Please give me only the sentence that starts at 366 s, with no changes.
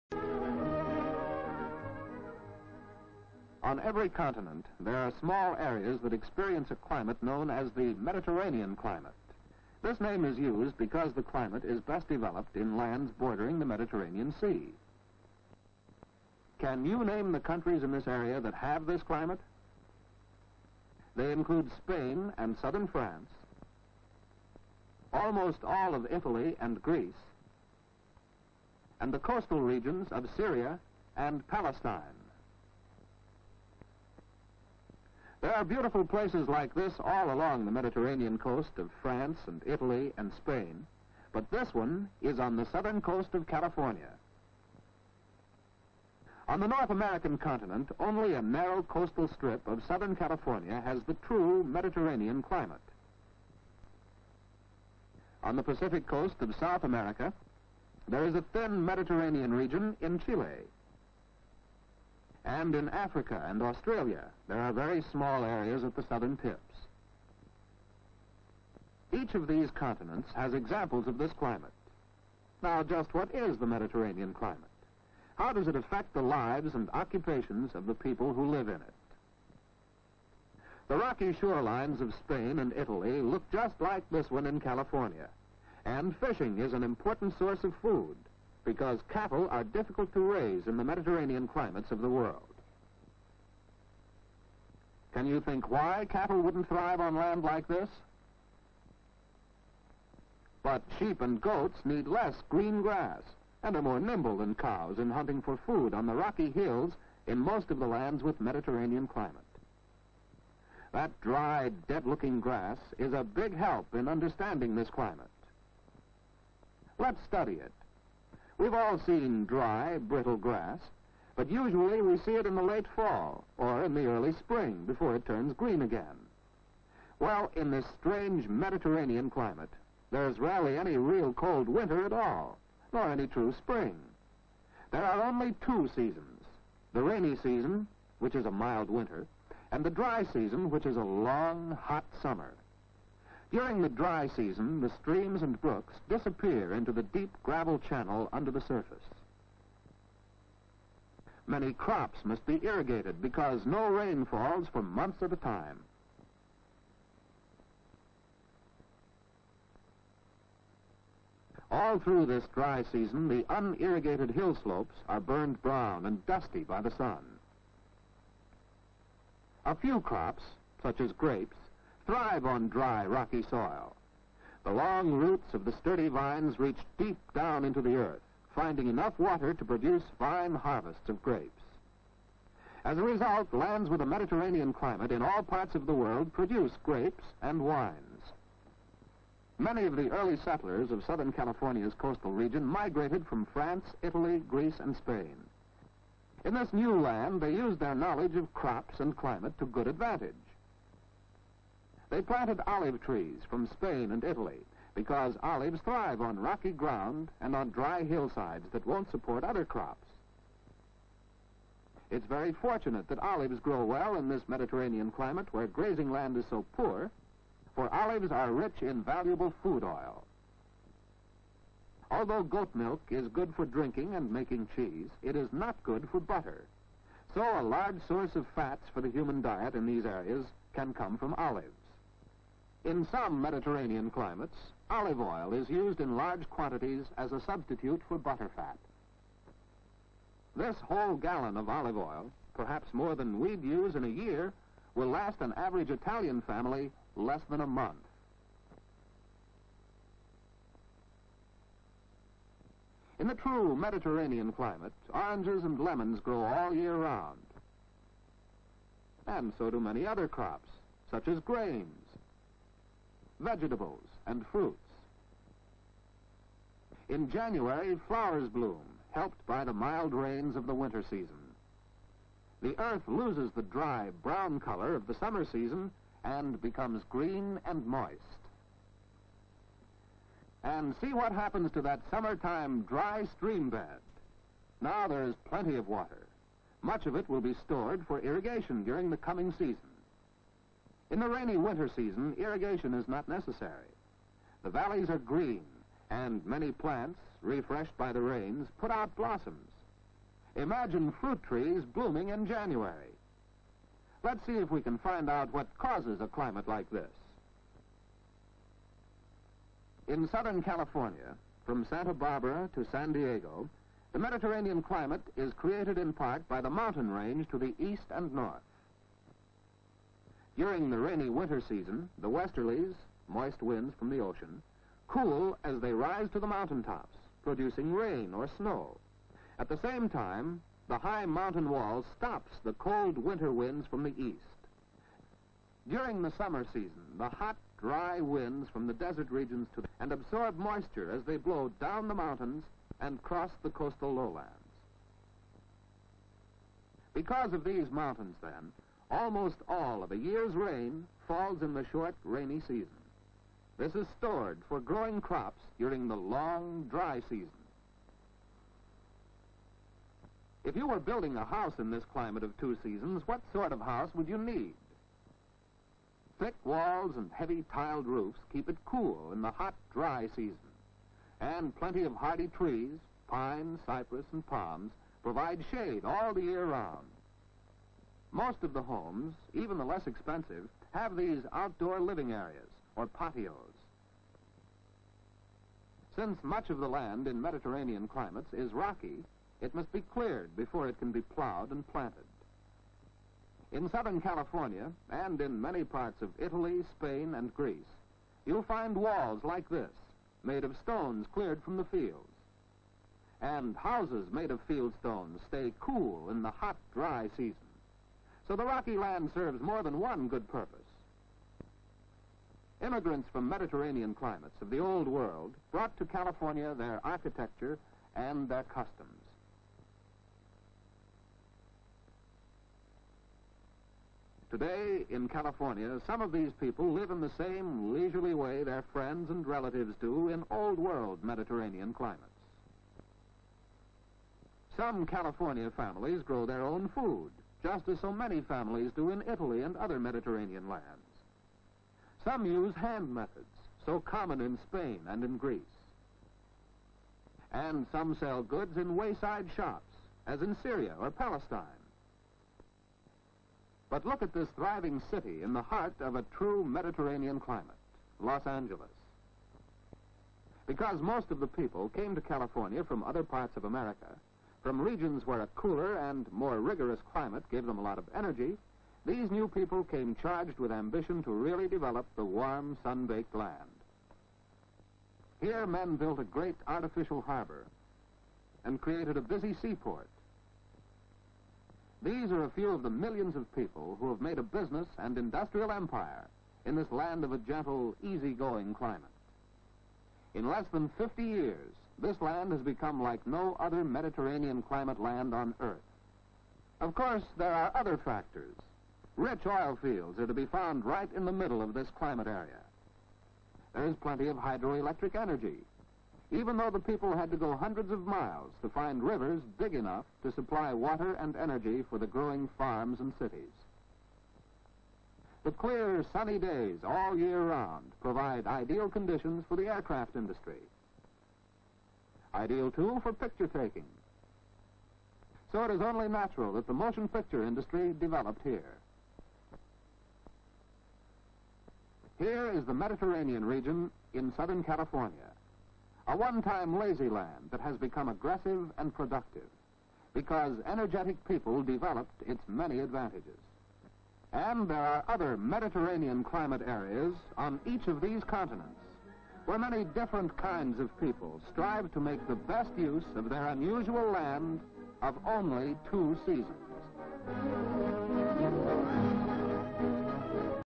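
Thick walls and heavy tiled roofs keep it cool in the hot, dry season.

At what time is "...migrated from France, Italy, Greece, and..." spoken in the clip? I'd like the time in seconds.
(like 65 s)
192 s.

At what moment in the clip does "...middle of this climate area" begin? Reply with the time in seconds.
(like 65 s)
501 s.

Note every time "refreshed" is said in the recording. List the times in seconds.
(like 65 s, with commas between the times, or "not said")
297 s.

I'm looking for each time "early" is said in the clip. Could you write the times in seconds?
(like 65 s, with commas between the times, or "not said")
124 s, 190 s.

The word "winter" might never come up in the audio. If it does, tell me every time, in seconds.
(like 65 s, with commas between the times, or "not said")
131 s, 138 s, 270 s, 291 s, 321 s, 333 s.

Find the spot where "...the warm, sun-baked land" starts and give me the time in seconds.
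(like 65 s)
472 s.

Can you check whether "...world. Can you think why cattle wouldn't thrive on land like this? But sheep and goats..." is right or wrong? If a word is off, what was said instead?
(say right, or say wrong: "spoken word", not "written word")
right.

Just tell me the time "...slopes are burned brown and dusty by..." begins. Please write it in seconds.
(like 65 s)
164 s.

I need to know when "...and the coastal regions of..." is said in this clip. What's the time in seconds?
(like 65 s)
28 s.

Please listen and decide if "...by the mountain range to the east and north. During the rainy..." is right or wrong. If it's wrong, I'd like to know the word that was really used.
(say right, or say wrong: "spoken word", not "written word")
right.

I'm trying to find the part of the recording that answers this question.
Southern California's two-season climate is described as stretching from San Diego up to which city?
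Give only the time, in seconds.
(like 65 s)
311 s.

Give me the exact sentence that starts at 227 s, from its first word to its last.
So a large source of fats for the human diet in these areas can come from olives.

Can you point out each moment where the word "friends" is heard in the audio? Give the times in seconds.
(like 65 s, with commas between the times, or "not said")
428 s.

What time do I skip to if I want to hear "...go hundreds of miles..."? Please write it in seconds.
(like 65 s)
507 s.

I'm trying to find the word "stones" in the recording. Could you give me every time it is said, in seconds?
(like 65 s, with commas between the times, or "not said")
400 s, 404 s.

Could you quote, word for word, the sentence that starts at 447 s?
And some sell goods in wayside shops, as in Syria or Palestine.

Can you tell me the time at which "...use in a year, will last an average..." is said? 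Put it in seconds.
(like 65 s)
243 s.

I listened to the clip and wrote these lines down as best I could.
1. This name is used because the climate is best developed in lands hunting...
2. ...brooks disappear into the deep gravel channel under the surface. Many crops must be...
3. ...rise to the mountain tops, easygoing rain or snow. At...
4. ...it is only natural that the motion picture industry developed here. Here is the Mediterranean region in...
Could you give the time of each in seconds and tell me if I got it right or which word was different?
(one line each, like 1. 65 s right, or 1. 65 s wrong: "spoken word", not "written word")
1. 9 s wrong: "bordering", not "hunting"
2. 145 s right
3. 325 s wrong: "producing", not "easygoing"
4. 525 s right.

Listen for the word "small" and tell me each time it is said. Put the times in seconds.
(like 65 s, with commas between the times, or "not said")
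5 s, 65 s.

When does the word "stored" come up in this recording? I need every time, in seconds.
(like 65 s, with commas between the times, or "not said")
287 s, 354 s.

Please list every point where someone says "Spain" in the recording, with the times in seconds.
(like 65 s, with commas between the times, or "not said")
21 s, 40 s, 82 s, 194 s, 203 s, 396 s, 444 s.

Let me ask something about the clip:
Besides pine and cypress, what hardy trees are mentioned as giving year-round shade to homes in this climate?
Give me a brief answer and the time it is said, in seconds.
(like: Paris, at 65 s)
Palms, at 374 s.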